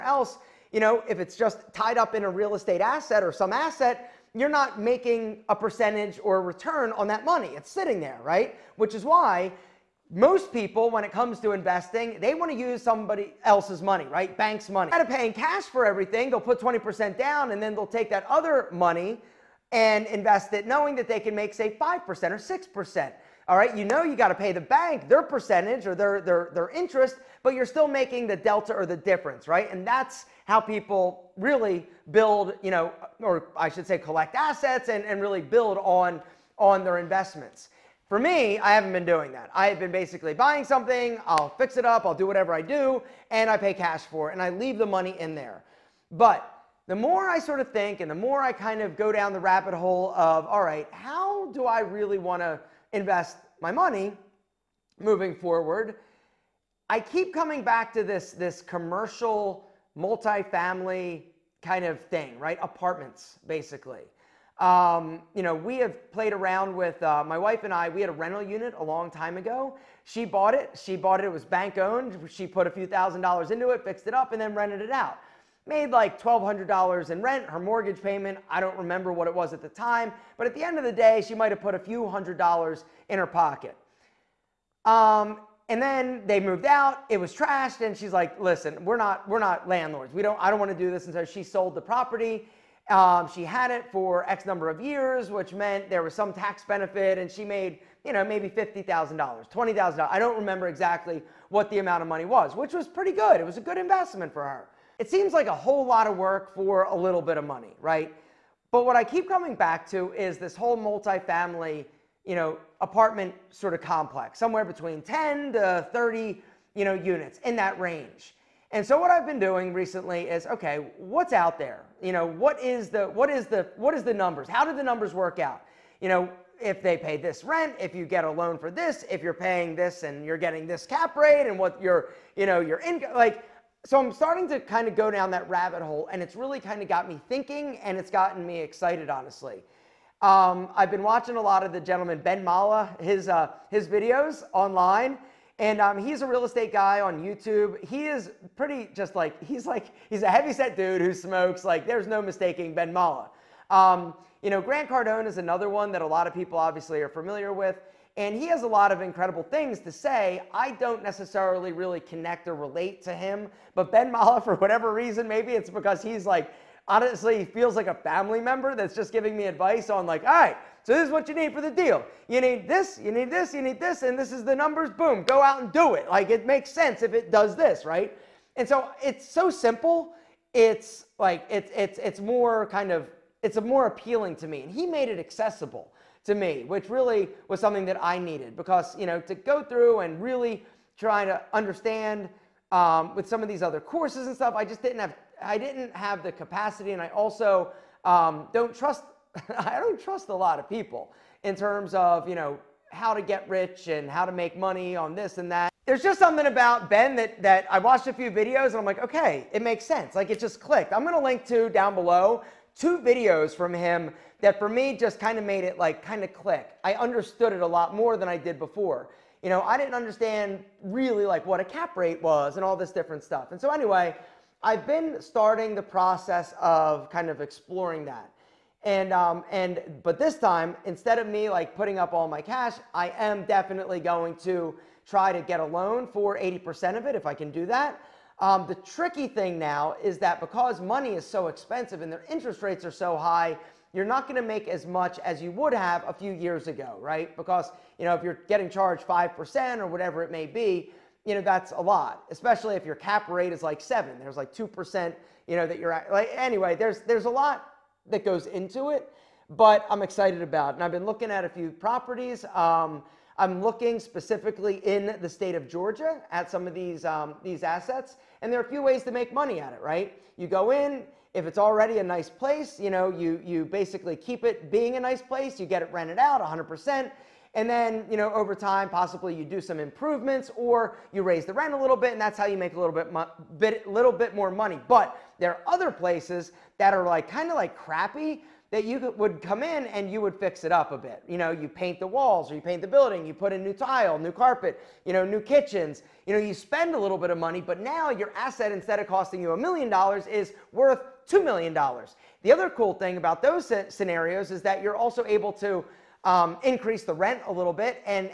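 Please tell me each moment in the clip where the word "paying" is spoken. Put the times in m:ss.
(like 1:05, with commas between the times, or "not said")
0:15, 2:09.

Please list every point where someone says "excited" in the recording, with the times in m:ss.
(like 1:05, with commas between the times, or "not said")
2:18, 4:20.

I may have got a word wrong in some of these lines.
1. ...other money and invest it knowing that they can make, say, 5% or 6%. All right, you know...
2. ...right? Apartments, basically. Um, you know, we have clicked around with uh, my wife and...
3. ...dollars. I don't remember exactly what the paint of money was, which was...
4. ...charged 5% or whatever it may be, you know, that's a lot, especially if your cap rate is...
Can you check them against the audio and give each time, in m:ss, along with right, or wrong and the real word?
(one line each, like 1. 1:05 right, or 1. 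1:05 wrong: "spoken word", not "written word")
1. 0:18 right
2. 1:02 wrong: "played", not "clicked"
3. 1:39 wrong: "amount", not "paint"
4. 4:08 right.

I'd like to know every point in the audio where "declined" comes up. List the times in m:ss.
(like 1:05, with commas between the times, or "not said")
not said.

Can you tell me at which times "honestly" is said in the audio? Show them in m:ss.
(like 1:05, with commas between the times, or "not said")
2:19, 2:46.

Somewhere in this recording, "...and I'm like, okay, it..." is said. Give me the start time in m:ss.
3:28.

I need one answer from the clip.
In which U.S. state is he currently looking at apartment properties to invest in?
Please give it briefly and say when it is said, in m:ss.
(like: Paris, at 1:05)
Georgia, at 4:25.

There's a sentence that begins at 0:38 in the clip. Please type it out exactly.
For me, I haven't been doing that.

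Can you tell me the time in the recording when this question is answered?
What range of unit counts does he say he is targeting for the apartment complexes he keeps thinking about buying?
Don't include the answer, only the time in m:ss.
1:55.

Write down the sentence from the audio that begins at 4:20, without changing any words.
and I've been looking at a few properties.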